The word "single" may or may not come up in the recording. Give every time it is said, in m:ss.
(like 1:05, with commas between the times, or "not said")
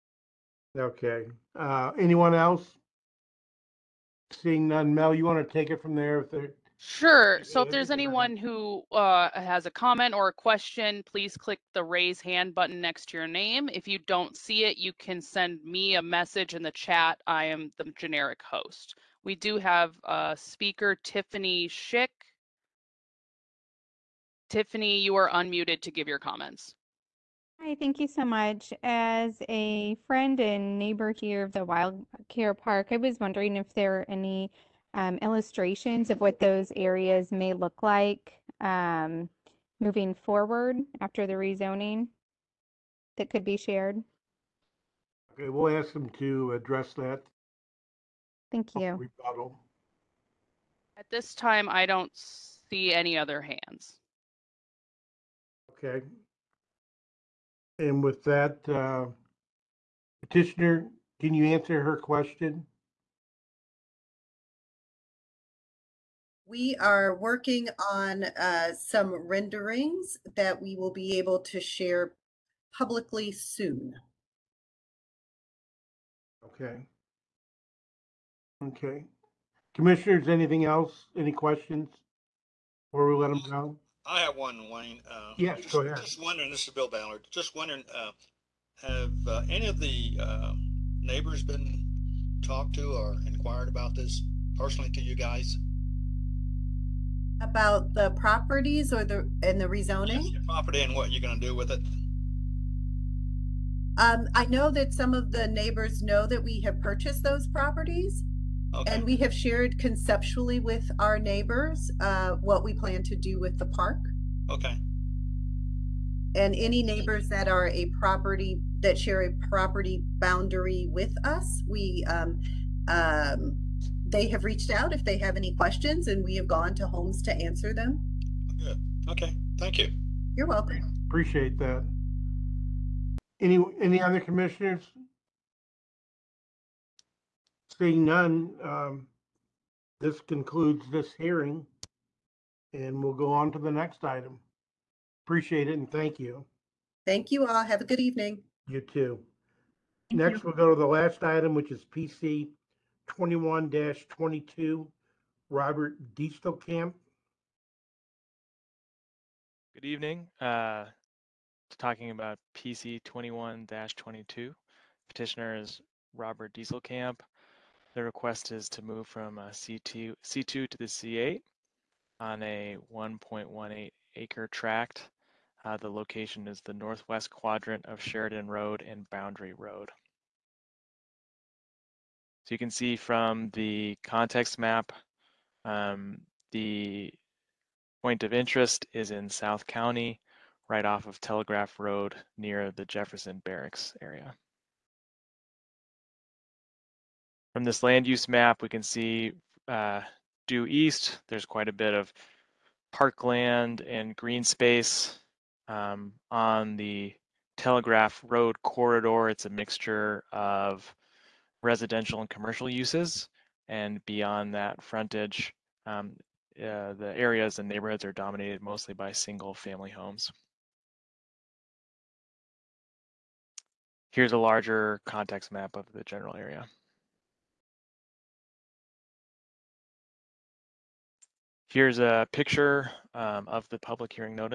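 3:39.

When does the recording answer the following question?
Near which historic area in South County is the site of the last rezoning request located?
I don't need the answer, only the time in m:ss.
3:12.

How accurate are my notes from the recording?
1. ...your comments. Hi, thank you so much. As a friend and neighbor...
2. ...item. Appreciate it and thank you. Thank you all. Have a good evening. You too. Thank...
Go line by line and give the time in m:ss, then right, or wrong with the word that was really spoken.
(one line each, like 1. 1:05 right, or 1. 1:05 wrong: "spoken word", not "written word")
1. 0:26 right
2. 2:24 right.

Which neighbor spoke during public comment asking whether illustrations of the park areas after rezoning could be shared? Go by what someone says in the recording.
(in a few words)
Tiffany Schick.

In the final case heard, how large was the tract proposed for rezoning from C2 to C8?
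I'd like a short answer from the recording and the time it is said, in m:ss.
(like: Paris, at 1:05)
1.18 acres, at 2:52.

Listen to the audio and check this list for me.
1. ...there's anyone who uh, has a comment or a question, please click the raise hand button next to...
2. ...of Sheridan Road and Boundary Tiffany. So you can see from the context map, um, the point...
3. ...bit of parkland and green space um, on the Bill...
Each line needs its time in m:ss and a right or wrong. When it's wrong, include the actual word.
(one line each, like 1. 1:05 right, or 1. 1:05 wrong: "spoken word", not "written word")
1. 0:07 right
2. 2:57 wrong: "Road", not "Tiffany"
3. 3:21 wrong: "Telegraph", not "Bill".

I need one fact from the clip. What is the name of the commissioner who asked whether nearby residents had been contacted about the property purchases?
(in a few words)
Bill Ballard.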